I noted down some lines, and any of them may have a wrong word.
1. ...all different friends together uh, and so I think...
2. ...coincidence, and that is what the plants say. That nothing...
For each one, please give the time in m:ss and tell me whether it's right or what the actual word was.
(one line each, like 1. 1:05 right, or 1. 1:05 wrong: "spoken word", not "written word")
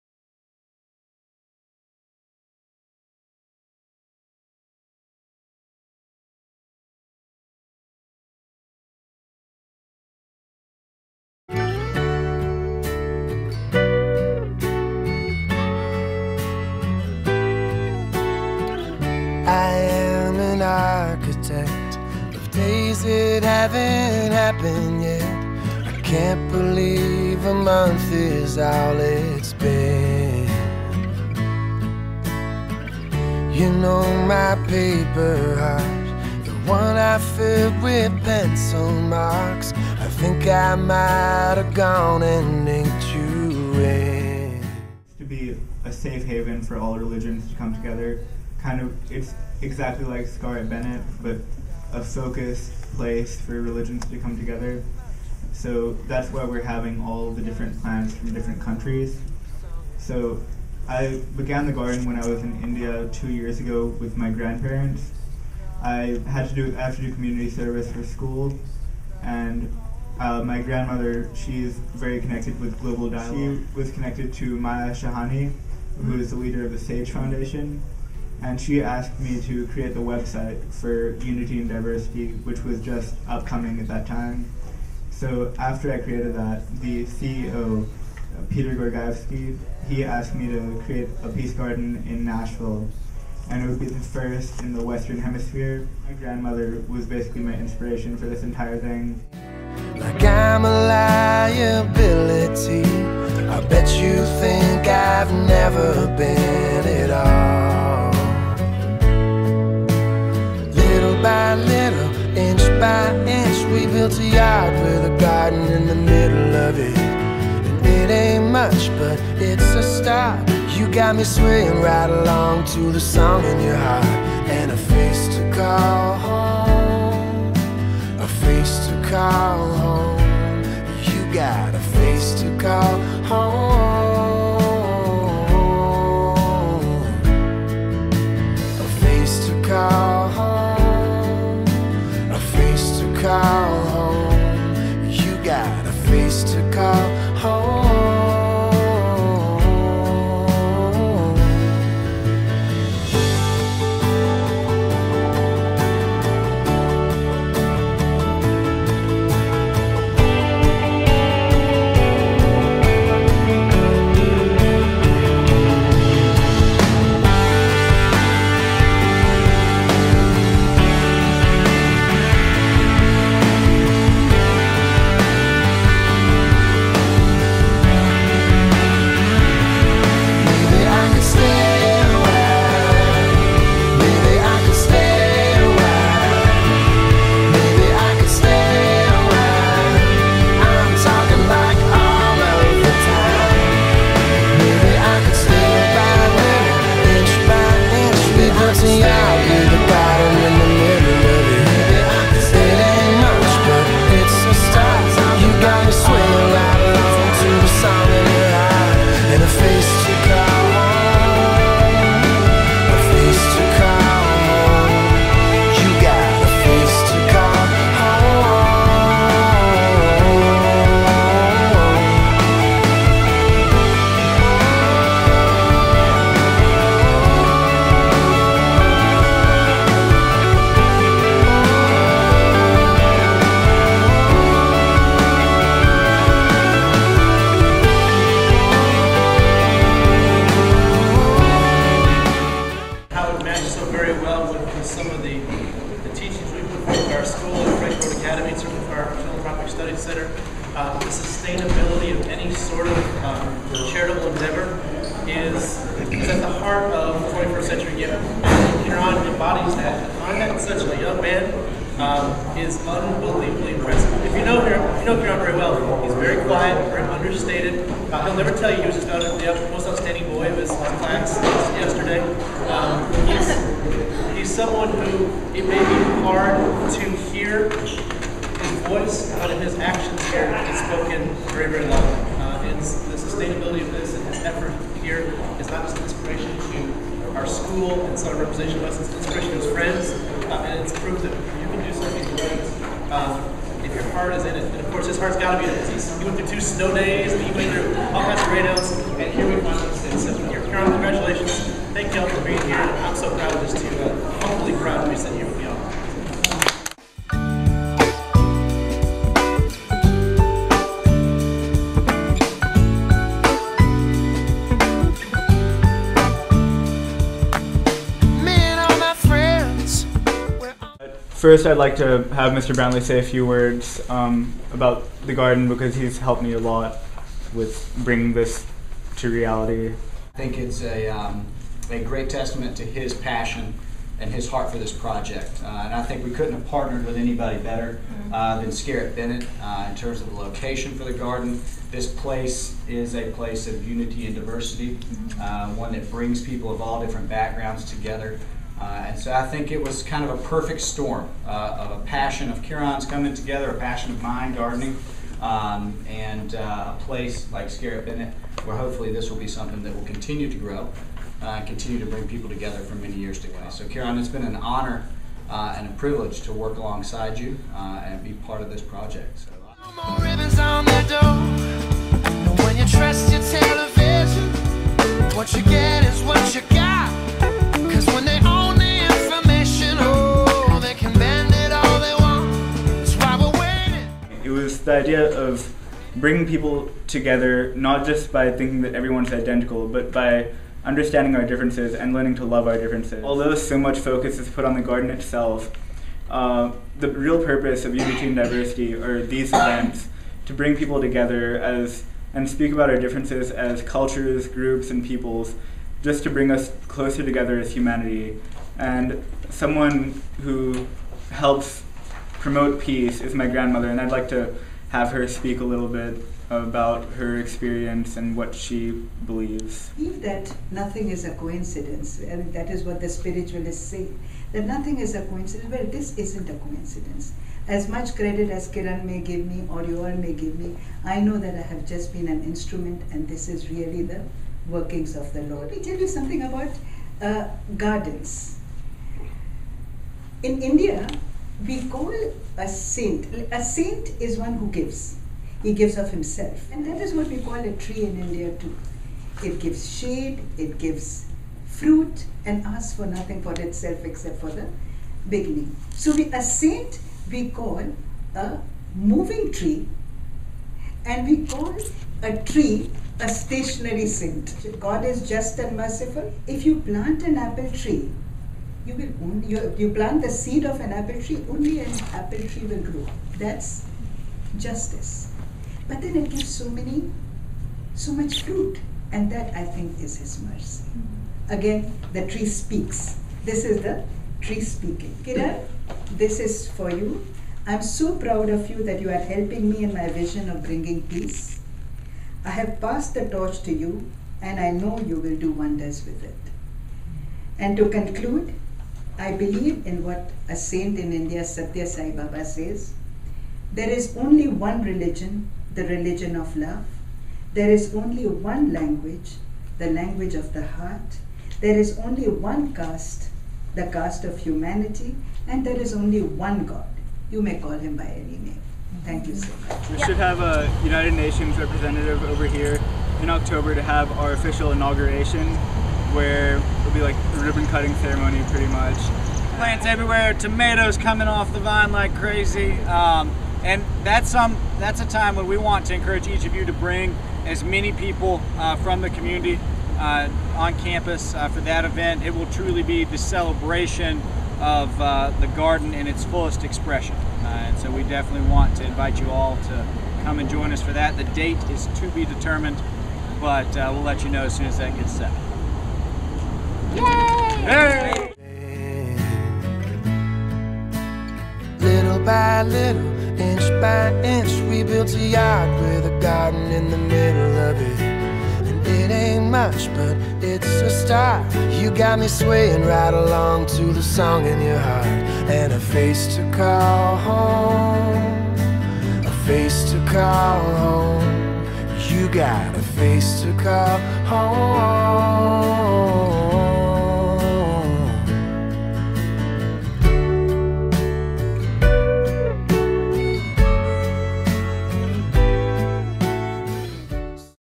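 1. 5:46 wrong: "backgrounds", not "friends"
2. 7:01 wrong: "spiritualists", not "plants".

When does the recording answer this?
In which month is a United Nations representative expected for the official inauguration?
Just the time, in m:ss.
8:43.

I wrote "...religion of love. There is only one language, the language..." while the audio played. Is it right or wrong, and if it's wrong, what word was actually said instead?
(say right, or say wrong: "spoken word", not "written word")
right.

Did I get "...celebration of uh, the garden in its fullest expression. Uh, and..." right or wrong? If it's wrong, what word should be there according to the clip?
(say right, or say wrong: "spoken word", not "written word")
right.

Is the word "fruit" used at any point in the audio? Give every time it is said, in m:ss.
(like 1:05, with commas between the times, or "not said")
7:31, 7:58.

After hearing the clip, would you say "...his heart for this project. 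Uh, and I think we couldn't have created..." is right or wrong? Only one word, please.
wrong.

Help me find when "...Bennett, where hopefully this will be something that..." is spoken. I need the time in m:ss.
5:58.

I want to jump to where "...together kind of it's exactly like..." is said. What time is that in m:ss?
0:47.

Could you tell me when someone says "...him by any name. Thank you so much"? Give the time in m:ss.
8:37.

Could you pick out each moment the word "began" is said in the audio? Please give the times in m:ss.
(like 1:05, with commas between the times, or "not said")
1:01.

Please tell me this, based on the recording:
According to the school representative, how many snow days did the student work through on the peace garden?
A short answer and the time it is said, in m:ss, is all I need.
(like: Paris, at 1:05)
2, at 4:56.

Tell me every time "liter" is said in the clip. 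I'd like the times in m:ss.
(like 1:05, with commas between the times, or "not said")
not said.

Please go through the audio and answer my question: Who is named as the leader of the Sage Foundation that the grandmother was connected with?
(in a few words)
Maya Shahani.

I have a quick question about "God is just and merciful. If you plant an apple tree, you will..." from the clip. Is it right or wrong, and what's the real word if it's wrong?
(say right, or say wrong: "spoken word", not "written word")
right.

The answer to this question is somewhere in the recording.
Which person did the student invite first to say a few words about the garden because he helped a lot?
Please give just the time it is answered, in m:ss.
5:22.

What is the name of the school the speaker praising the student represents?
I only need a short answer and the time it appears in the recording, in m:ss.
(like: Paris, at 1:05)
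Freshwater Academy, at 4:07.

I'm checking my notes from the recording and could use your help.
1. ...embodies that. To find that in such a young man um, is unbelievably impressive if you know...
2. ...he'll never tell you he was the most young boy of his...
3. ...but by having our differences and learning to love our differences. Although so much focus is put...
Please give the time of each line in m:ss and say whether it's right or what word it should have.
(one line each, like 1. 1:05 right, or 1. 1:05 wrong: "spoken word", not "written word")
1. 4:19 right
2. 4:28 wrong: "outstanding", not "young"
3. 6:29 wrong: "understanding", not "having".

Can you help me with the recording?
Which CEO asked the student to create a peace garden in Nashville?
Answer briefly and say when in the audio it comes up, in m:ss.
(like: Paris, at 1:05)
Peter Gorgaevsky, at 1:28.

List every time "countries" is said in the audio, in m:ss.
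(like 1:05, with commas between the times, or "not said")
0:58.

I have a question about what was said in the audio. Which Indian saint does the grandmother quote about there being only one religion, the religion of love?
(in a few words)
Satya Sai Baba.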